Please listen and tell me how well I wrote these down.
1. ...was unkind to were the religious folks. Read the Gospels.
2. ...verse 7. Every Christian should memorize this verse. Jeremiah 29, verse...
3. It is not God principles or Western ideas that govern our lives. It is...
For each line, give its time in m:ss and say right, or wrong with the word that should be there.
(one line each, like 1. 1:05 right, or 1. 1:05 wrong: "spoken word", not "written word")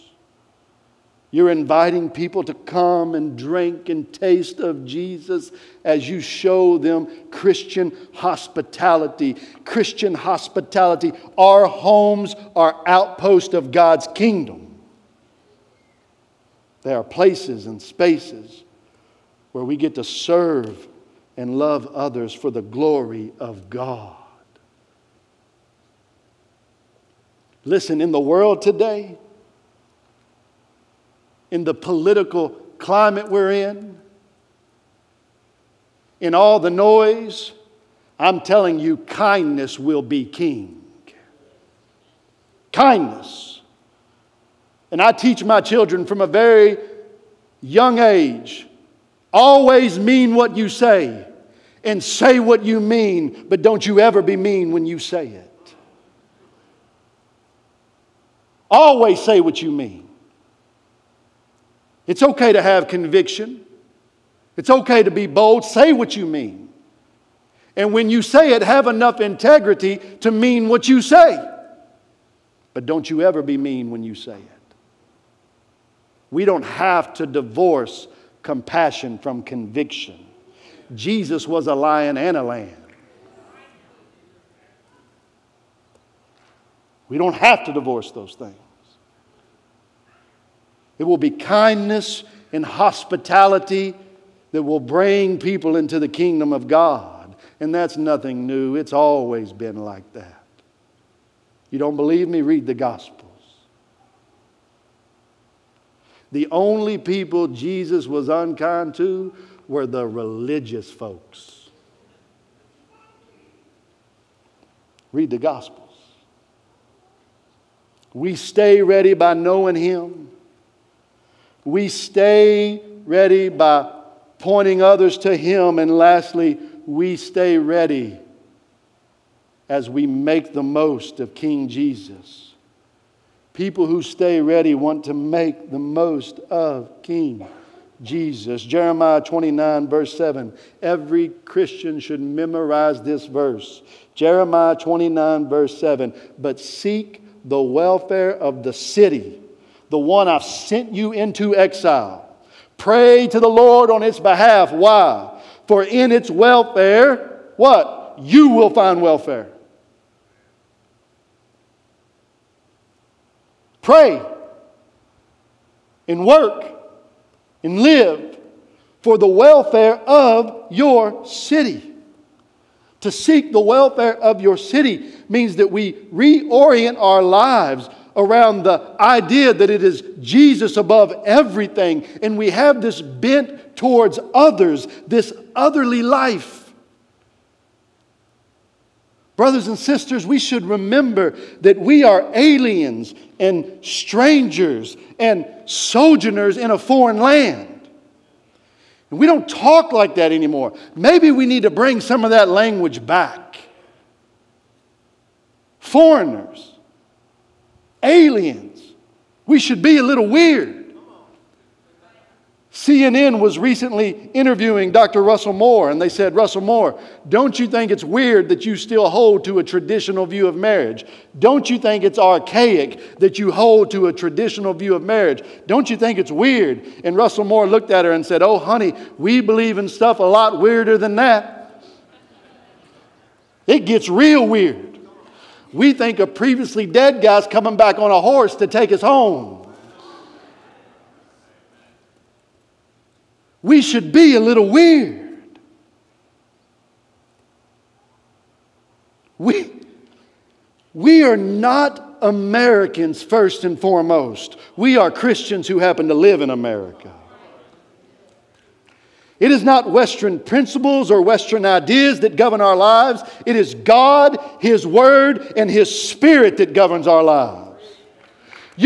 1. 1:48 right
2. 2:19 right
3. 4:19 wrong: "Western", not "God".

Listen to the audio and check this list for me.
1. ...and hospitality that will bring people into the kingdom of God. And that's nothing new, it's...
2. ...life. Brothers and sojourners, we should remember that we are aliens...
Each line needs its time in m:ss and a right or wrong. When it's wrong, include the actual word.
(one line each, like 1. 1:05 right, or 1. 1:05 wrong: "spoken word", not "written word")
1. 1:32 right
2. 3:06 wrong: "sisters", not "sojourners".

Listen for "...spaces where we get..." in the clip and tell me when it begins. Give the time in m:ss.
0:17.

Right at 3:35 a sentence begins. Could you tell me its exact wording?
Russell Moore, and they said, Russell Moore, don't you think it's weird that you still hold to a traditional view of marriage?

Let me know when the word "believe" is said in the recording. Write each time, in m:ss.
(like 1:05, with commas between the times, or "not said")
1:41, 3:49.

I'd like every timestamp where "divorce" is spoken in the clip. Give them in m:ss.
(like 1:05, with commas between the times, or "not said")
1:17, 1:27.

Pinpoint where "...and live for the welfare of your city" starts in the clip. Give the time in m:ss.
2:47.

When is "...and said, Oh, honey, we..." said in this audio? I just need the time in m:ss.
3:48.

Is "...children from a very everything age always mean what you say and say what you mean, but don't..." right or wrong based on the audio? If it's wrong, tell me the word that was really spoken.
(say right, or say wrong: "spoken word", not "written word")
wrong: "young", not "everything".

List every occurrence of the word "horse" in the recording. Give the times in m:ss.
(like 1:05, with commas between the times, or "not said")
3:58.